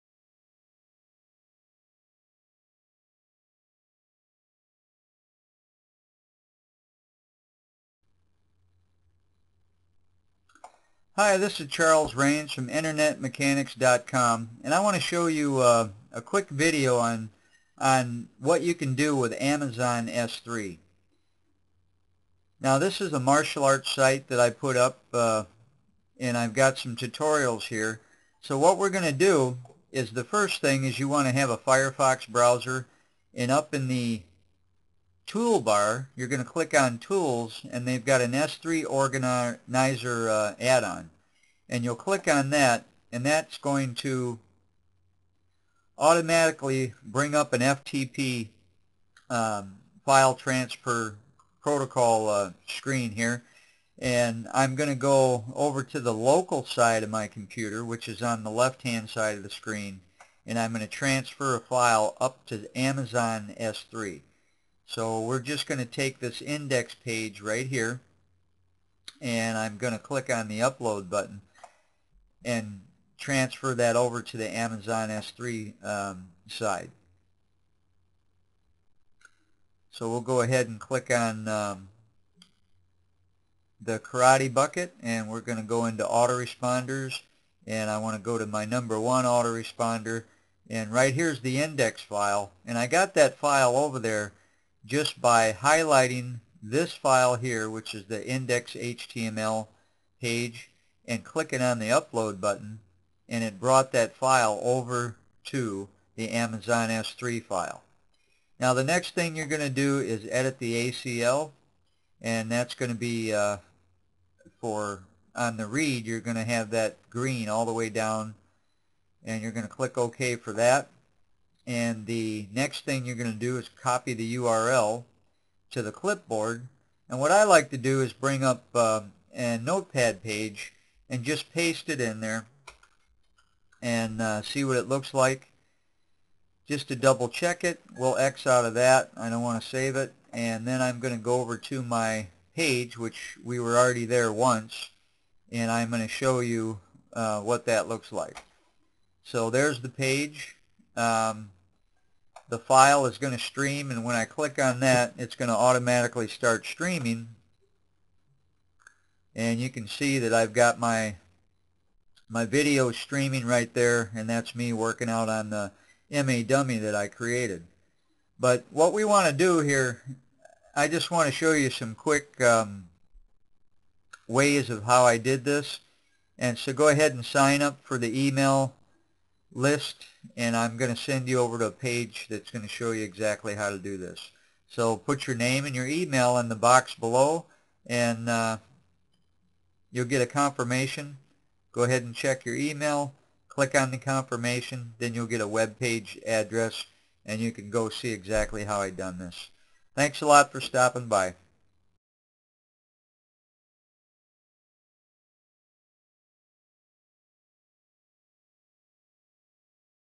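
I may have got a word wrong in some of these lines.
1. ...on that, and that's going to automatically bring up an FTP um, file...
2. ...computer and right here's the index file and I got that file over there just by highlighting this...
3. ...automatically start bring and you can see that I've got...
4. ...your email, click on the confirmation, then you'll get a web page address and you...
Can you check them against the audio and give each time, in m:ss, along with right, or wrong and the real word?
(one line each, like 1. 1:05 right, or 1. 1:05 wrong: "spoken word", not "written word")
1. 0:42 right
2. 1:29 wrong: "autoresponder", not "computer"
3. 2:35 wrong: "streaming", not "bring"
4. 3:12 right.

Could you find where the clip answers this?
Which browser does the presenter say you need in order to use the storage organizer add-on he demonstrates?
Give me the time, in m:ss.
0:31.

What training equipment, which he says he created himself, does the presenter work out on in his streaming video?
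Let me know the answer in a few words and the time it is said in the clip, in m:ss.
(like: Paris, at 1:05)
MA dummy, at 2:46.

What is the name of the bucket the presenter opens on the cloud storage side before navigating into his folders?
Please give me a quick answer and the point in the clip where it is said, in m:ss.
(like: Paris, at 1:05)
karate, at 1:23.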